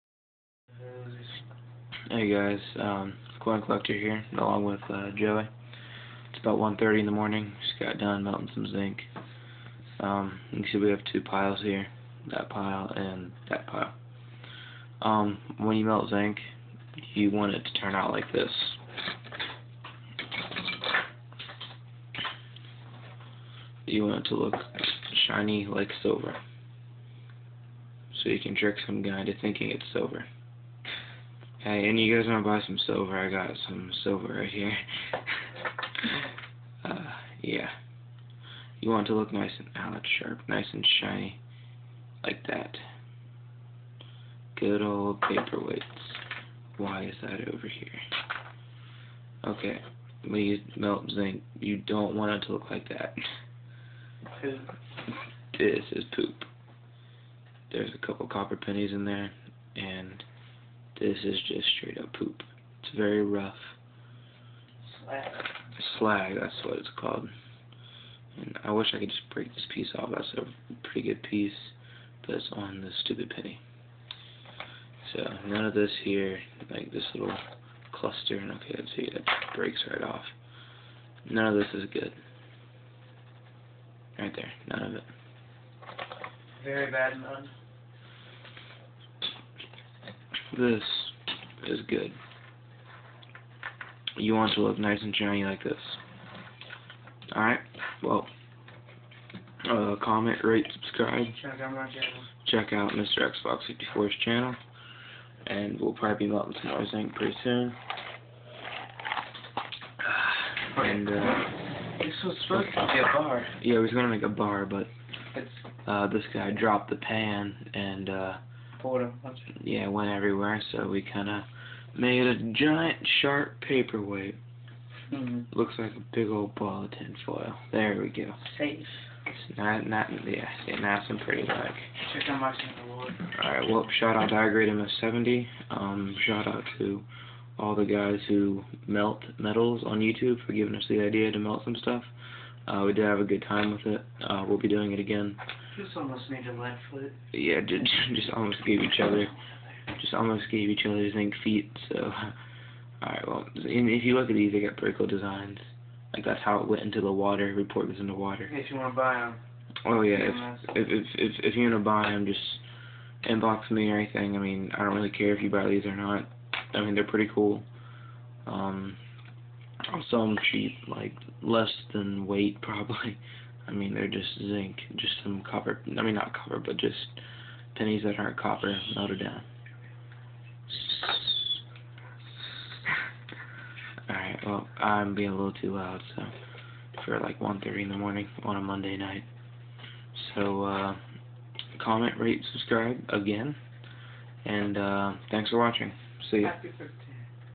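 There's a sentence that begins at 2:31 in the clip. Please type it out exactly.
So, all right, well, if you look at these, they got pretty cool designs.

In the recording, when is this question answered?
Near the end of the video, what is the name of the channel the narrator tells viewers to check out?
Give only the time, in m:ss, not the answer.
1:42.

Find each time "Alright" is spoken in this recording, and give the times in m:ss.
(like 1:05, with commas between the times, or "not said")
1:37, 2:13, 3:04.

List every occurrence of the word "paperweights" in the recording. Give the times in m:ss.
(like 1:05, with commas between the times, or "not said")
0:45, 2:03.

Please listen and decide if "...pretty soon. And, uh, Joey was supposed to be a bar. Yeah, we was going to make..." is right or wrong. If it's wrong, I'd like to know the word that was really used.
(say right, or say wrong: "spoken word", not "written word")
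wrong: "This", not "Joey".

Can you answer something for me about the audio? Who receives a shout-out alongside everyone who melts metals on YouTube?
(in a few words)
iGrade MS70.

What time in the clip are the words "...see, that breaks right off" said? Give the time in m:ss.
1:18.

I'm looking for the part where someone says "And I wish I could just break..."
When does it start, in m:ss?
1:08.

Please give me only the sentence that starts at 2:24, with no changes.
Uh, we'll be doing it again.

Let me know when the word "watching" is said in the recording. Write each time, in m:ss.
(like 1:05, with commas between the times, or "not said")
3:15.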